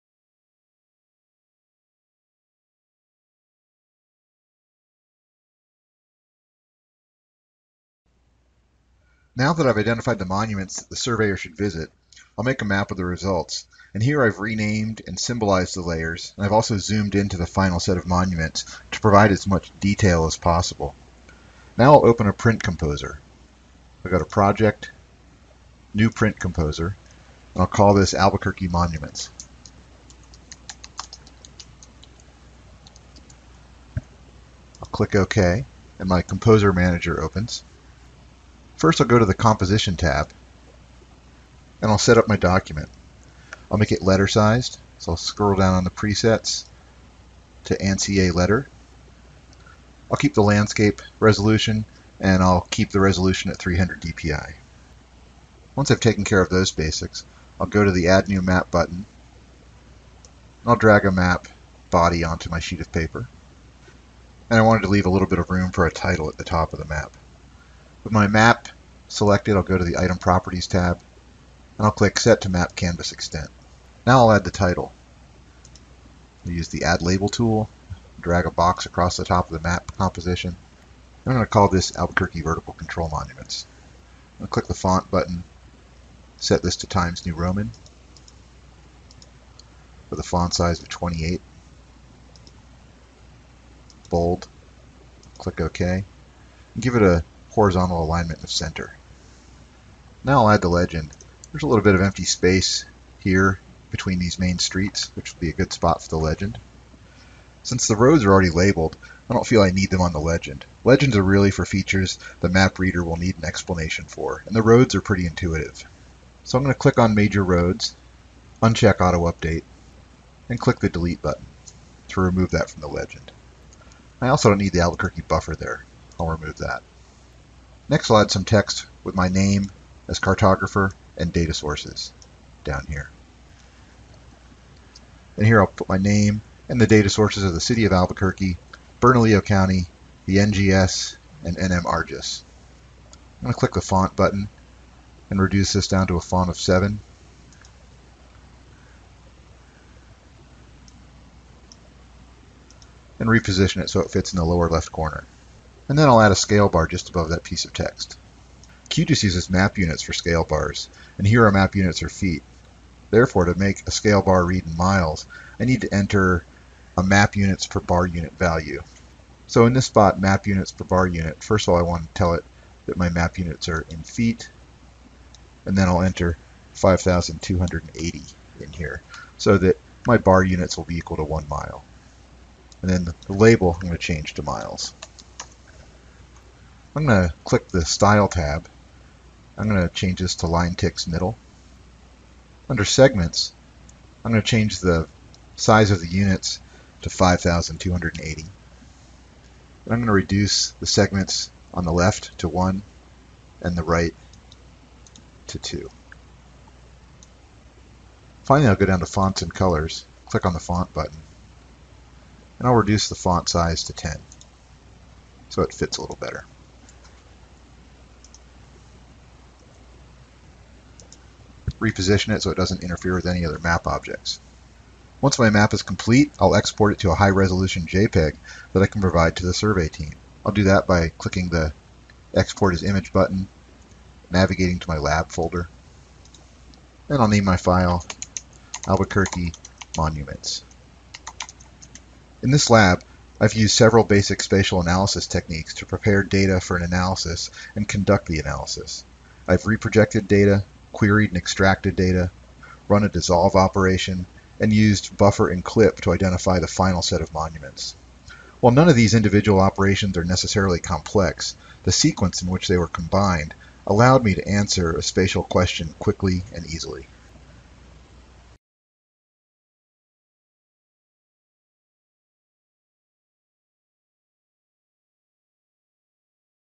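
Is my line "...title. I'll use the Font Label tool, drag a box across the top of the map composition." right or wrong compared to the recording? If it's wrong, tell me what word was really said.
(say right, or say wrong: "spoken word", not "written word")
wrong: "Add", not "Font".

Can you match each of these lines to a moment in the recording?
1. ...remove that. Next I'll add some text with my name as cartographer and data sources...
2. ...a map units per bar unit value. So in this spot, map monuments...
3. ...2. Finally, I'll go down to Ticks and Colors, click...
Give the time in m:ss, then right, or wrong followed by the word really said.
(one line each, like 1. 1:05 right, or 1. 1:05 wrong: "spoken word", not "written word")
1. 2:06 right
2. 2:46 wrong: "units", not "monuments"
3. 3:25 wrong: "Fonts", not "Ticks".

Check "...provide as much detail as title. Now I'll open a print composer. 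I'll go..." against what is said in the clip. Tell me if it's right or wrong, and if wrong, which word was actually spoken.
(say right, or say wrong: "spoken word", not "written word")
wrong: "possible", not "title".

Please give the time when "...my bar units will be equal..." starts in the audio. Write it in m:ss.
3:00.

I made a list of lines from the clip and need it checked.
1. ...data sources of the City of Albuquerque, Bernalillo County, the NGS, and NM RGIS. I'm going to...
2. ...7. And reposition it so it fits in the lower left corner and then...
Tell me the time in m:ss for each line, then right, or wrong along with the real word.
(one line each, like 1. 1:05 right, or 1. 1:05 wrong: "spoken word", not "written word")
1. 2:16 right
2. 2:26 right.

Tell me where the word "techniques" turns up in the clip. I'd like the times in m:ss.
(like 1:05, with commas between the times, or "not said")
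4:05.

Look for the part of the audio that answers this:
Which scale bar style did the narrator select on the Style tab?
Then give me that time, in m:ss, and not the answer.
3:10.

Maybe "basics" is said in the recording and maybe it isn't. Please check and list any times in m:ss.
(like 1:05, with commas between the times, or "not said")
0:56, 4:04.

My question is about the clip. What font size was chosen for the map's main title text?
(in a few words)
28.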